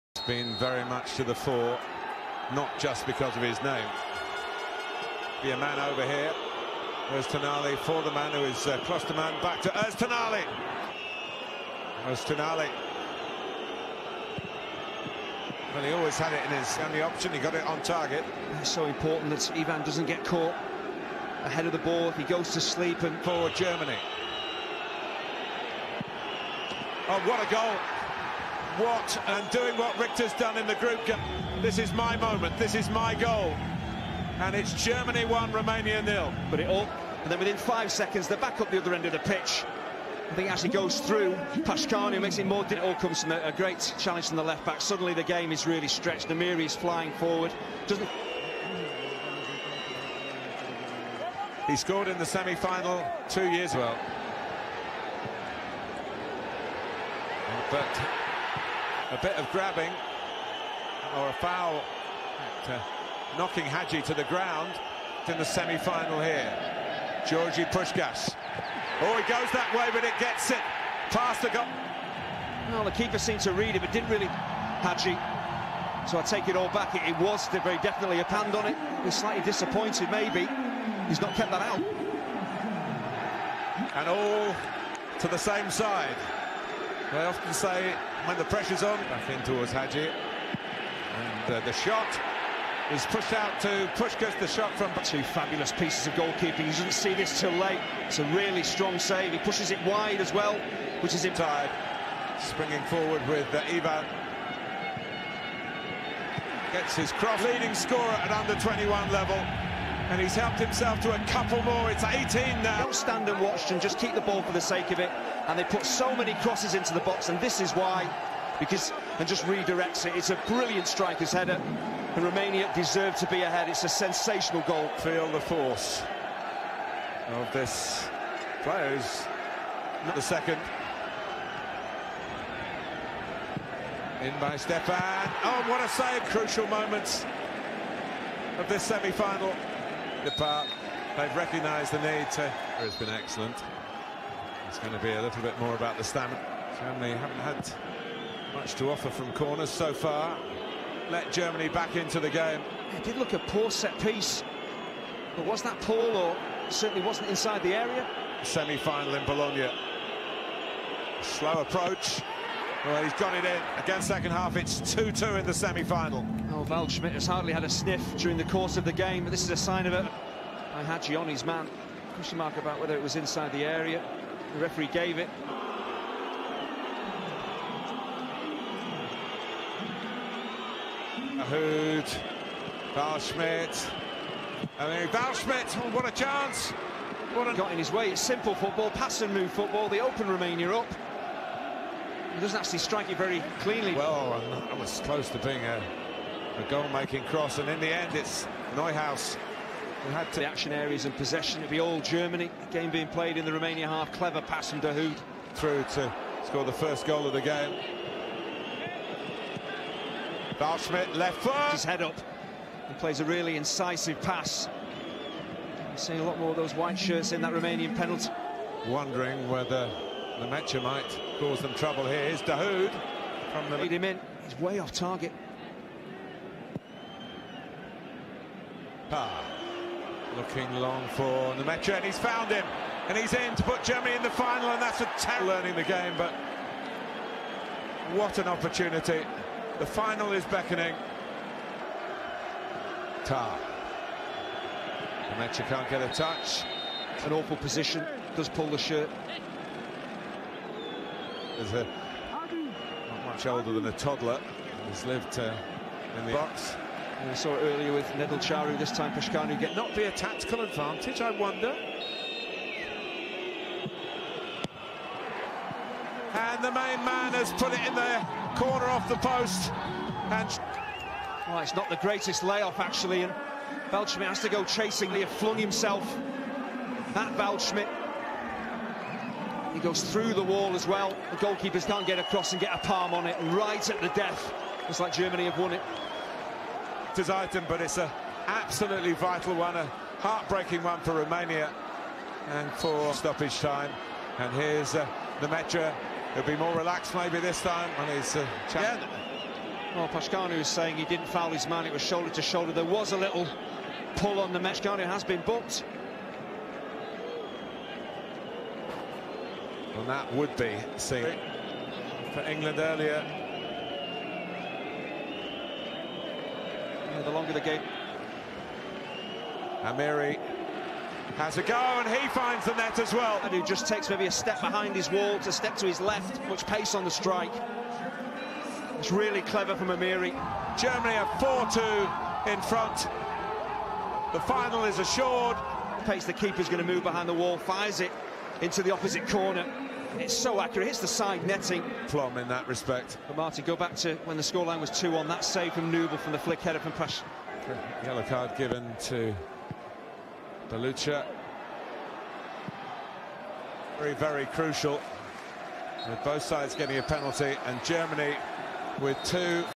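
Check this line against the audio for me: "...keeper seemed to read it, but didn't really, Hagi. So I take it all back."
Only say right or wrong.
right.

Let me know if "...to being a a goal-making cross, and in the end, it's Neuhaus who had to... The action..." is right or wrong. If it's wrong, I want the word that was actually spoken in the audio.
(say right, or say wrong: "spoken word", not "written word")
right.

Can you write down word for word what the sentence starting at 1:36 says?
You didn't see this till late.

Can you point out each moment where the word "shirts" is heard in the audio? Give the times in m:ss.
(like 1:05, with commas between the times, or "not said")
3:36, 4:08.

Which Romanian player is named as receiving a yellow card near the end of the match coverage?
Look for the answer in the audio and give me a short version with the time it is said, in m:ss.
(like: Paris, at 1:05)
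Băluță, at 5:50.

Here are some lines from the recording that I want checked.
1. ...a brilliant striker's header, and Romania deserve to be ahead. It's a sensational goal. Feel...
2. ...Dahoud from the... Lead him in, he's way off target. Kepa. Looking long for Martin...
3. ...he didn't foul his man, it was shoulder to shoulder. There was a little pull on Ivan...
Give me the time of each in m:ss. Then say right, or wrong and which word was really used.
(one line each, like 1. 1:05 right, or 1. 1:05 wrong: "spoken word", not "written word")
1. 2:00 right
2. 3:42 wrong: "Nmecha", not "Martin"
3. 5:00 wrong: "Nmecha", not "Ivan".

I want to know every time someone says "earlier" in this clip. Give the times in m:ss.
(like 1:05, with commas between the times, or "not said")
4:17, 5:12.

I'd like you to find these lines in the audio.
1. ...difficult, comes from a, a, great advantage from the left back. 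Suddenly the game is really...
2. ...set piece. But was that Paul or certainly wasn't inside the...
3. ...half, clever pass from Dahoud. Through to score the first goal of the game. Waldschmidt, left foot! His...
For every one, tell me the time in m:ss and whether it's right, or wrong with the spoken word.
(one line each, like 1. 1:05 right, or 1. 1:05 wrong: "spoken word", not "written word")
1. 0:42 wrong: "challenge", not "advantage"
2. 2:33 right
3. 3:23 right.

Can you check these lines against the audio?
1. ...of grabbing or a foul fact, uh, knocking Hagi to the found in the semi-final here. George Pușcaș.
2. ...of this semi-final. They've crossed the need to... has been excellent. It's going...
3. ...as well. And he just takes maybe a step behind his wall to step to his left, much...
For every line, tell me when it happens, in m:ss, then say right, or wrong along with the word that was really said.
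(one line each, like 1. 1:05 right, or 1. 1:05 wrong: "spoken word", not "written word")
1. 0:59 wrong: "ground", not "found"
2. 2:18 wrong: "recognised", not "crossed"
3. 5:22 right.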